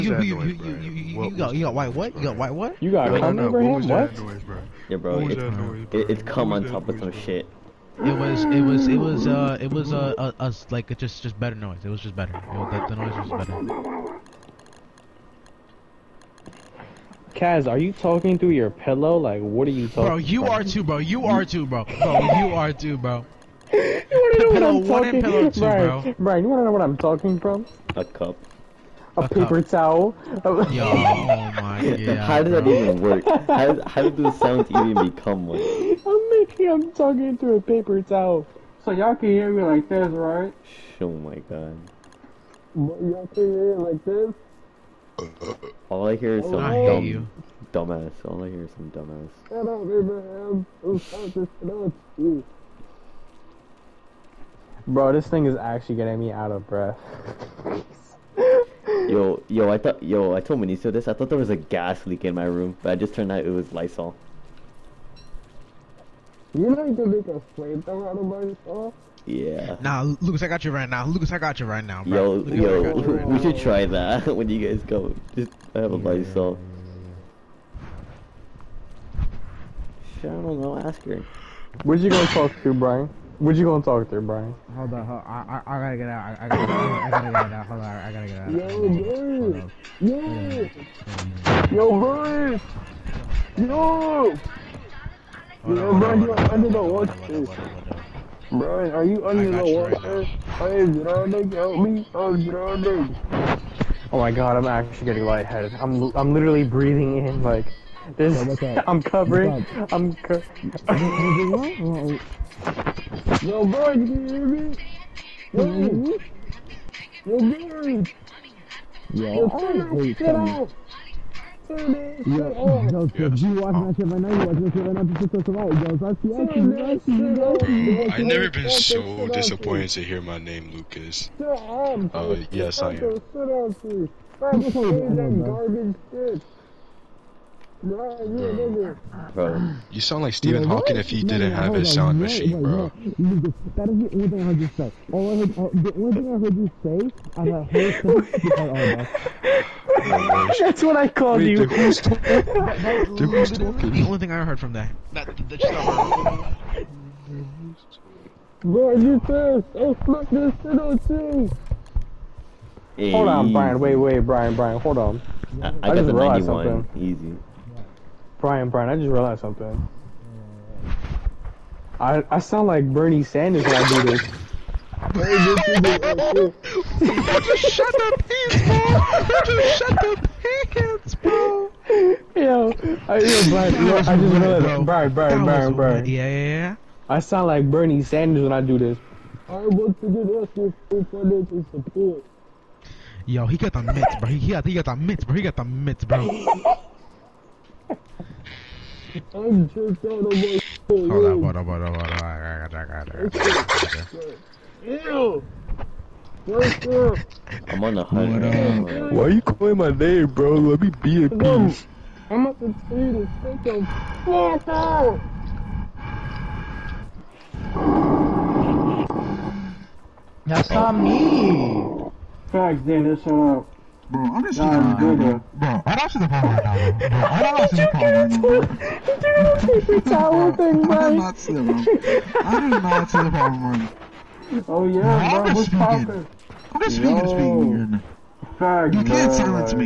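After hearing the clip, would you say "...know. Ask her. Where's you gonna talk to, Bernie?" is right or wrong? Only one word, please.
wrong.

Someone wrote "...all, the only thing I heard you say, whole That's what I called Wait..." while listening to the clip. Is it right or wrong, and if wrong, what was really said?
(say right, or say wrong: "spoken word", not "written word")
right.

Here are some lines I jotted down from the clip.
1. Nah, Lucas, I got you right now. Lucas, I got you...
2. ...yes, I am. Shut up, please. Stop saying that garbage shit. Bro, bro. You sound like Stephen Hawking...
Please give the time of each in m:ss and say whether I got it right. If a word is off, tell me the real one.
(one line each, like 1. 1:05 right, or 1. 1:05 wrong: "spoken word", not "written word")
1. 1:09 right
2. 2:12 right.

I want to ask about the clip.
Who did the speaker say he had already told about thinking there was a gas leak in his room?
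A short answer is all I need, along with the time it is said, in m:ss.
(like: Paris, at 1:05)
Maniso, at 1:00.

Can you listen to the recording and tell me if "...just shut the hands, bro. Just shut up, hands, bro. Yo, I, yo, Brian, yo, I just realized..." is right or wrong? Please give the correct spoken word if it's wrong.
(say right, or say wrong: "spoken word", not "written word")
right.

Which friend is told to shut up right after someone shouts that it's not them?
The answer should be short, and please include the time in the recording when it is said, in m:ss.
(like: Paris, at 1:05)
Xander, at 3:42.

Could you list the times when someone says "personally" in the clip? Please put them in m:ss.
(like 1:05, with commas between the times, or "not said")
not said.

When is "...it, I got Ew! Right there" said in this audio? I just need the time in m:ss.
3:23.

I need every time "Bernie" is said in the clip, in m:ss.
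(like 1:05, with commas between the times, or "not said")
2:52, 3:07.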